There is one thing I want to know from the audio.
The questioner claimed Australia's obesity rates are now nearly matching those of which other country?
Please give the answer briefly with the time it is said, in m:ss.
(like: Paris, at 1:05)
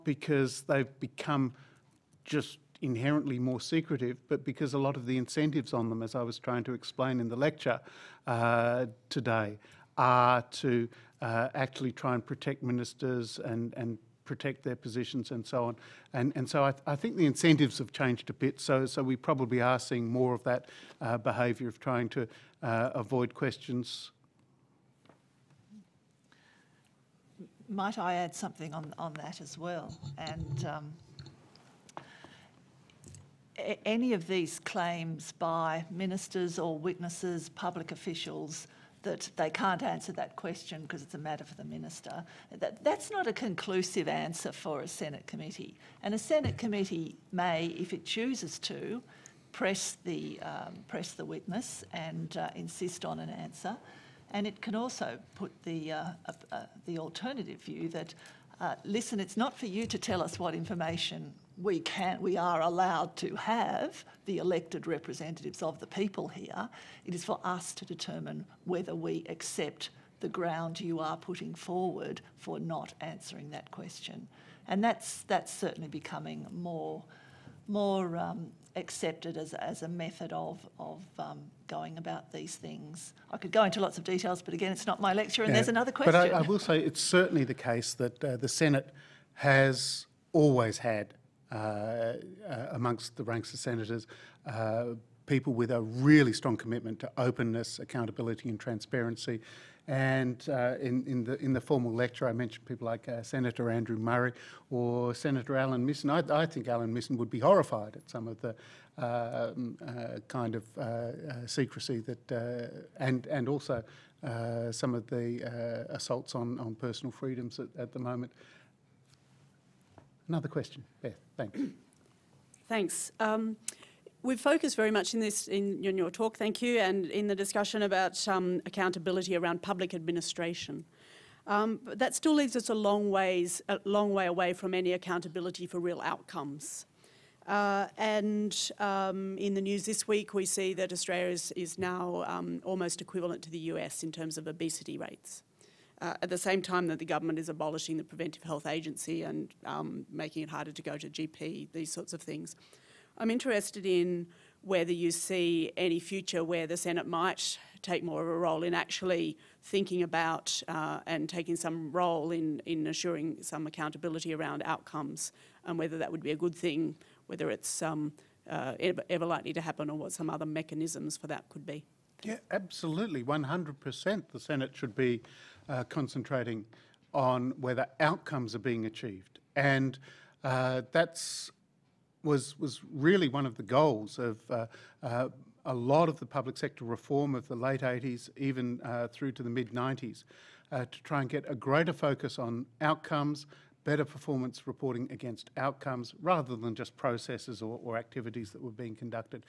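the US, at 2:23.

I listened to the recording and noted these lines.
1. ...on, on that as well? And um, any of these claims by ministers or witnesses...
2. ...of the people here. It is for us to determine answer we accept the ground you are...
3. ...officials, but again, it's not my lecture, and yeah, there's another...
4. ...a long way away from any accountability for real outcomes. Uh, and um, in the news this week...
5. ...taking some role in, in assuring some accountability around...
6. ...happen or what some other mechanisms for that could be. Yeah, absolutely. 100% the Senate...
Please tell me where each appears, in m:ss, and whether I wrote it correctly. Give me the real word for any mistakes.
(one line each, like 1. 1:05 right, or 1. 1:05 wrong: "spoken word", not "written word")
1. 0:28 right
2. 1:05 wrong: "whether", not "answer"
3. 1:24 wrong: "details", not "officials"
4. 2:13 right
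5. 2:41 right
6. 2:49 right.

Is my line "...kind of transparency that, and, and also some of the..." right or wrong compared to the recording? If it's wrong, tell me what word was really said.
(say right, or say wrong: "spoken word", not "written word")
wrong: "secrecy", not "transparency".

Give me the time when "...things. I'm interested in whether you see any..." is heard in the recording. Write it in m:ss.
2:32.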